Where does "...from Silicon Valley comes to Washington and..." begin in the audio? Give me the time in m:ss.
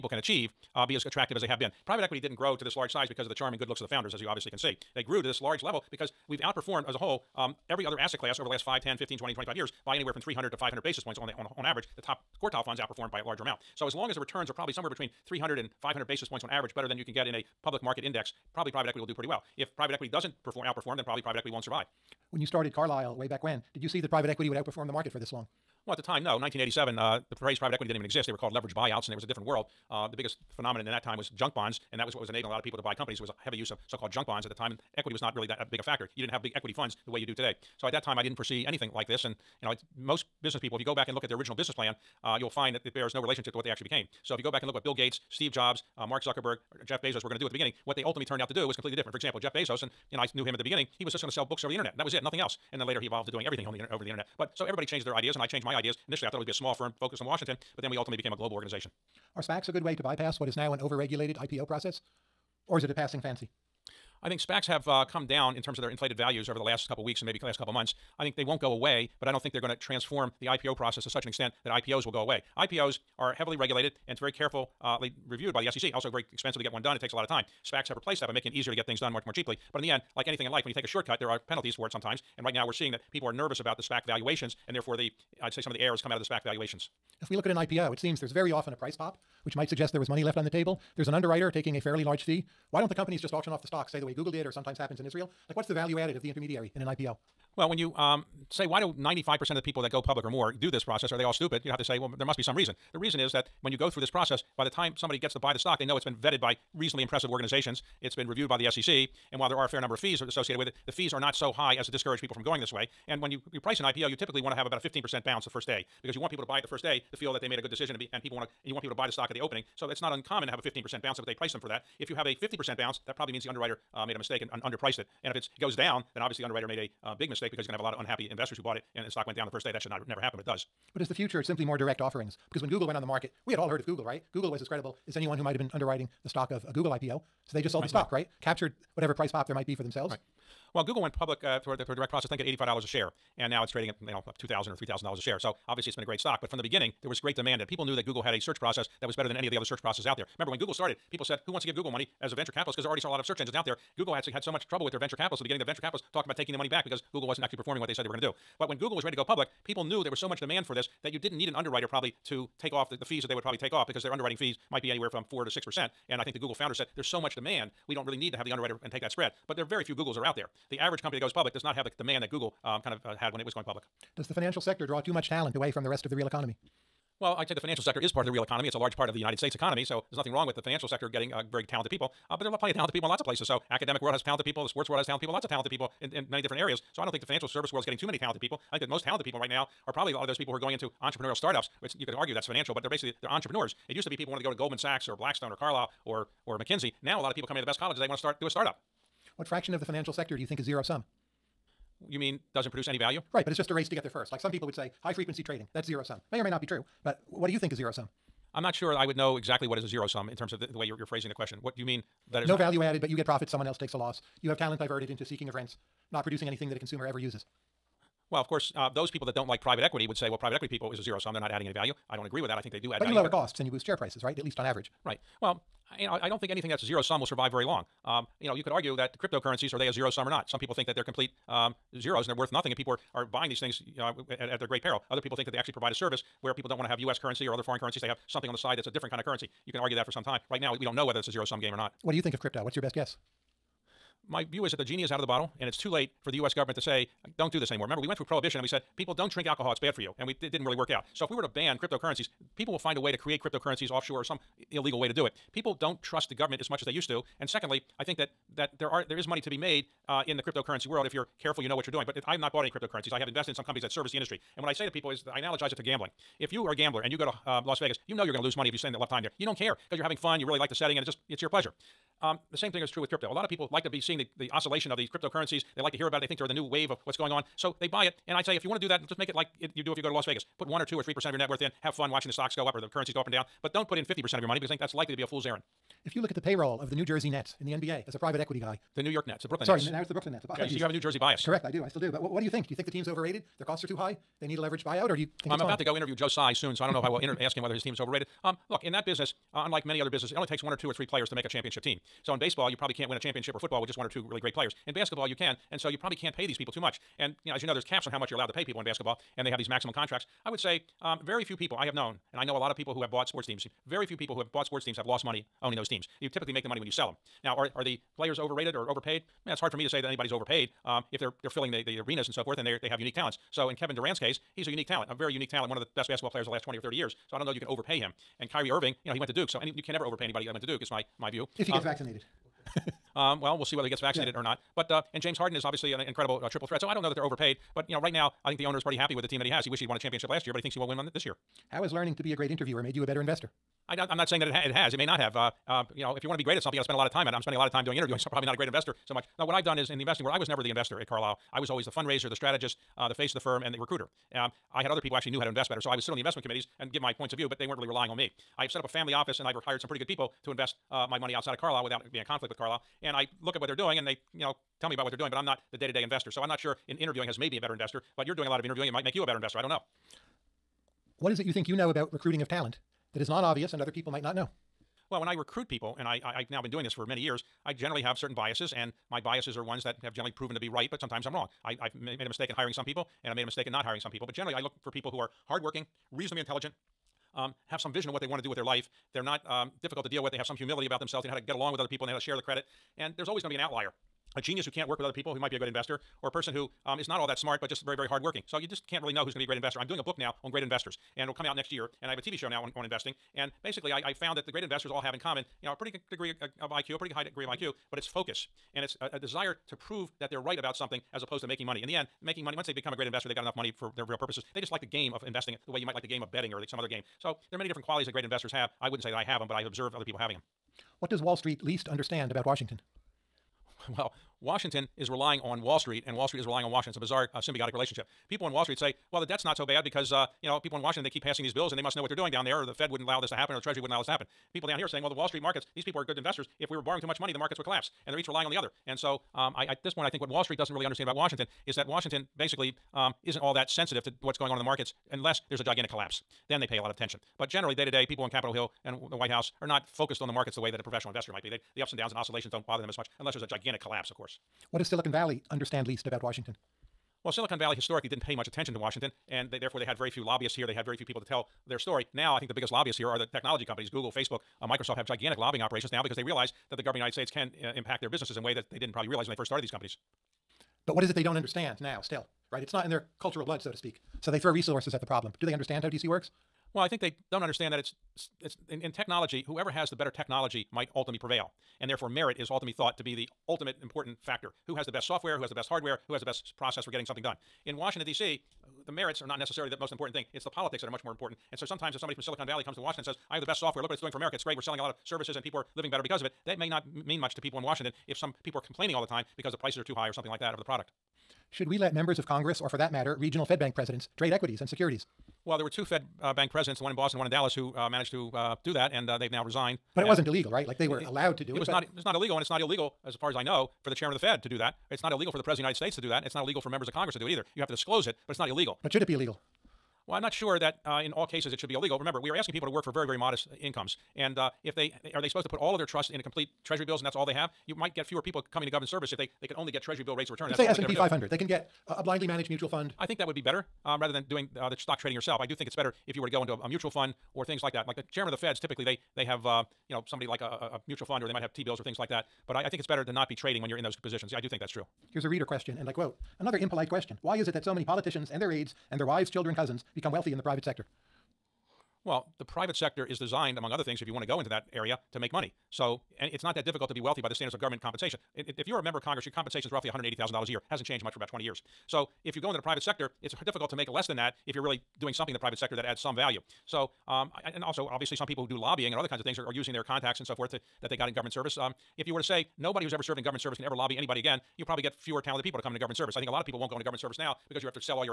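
8:12.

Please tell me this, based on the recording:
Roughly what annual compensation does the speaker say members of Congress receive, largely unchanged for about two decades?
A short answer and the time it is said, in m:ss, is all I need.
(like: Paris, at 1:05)
$180,000, at 9:19.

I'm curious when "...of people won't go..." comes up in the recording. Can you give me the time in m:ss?
9:36.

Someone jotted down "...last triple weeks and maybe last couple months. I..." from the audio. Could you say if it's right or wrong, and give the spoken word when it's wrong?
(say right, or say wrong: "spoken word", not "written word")
wrong: "couple", not "triple".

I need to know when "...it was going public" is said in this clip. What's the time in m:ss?
2:53.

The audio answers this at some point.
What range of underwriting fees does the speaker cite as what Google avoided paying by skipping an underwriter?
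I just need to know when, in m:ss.
2:45.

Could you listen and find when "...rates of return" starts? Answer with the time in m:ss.
8:50.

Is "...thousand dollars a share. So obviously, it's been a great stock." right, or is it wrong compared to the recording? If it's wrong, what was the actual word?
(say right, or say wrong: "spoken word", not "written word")
right.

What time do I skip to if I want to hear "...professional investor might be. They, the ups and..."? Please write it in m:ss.
7:30.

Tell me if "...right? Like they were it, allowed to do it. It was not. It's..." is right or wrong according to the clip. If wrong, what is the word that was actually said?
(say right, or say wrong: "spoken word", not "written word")
right.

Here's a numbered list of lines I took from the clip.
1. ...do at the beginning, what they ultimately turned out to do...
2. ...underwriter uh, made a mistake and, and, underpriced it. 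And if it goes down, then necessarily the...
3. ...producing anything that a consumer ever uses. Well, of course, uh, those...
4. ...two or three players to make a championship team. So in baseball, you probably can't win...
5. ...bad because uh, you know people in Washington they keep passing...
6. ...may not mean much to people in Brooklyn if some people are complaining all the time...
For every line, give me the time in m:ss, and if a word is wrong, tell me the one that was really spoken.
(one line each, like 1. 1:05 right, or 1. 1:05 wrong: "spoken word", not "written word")
1. 0:47 right
2. 2:03 wrong: "obviously", not "necessarily"
3. 3:36 right
4. 5:00 right
5. 7:09 right
6. 8:16 wrong: "Washington", not "Brooklyn".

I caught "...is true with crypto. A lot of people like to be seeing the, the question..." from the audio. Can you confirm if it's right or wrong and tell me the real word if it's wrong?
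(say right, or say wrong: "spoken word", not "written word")
wrong: "oscillation", not "question".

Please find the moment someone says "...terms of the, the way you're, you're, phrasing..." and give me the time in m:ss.
3:30.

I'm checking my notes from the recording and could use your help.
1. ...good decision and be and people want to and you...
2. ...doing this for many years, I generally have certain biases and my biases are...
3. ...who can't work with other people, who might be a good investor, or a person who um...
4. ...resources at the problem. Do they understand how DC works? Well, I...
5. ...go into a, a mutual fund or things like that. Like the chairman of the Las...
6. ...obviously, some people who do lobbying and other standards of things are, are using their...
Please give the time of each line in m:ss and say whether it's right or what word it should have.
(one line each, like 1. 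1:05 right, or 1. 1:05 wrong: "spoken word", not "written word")
1. 1:57 right
2. 6:16 right
3. 6:34 right
4. 7:54 right
5. 8:56 wrong: "Feds", not "Las"
6. 9:27 wrong: "kinds", not "standards".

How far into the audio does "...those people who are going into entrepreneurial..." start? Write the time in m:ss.
3:10.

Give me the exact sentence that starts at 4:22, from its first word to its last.
But I've not bought any cryptocurrencies.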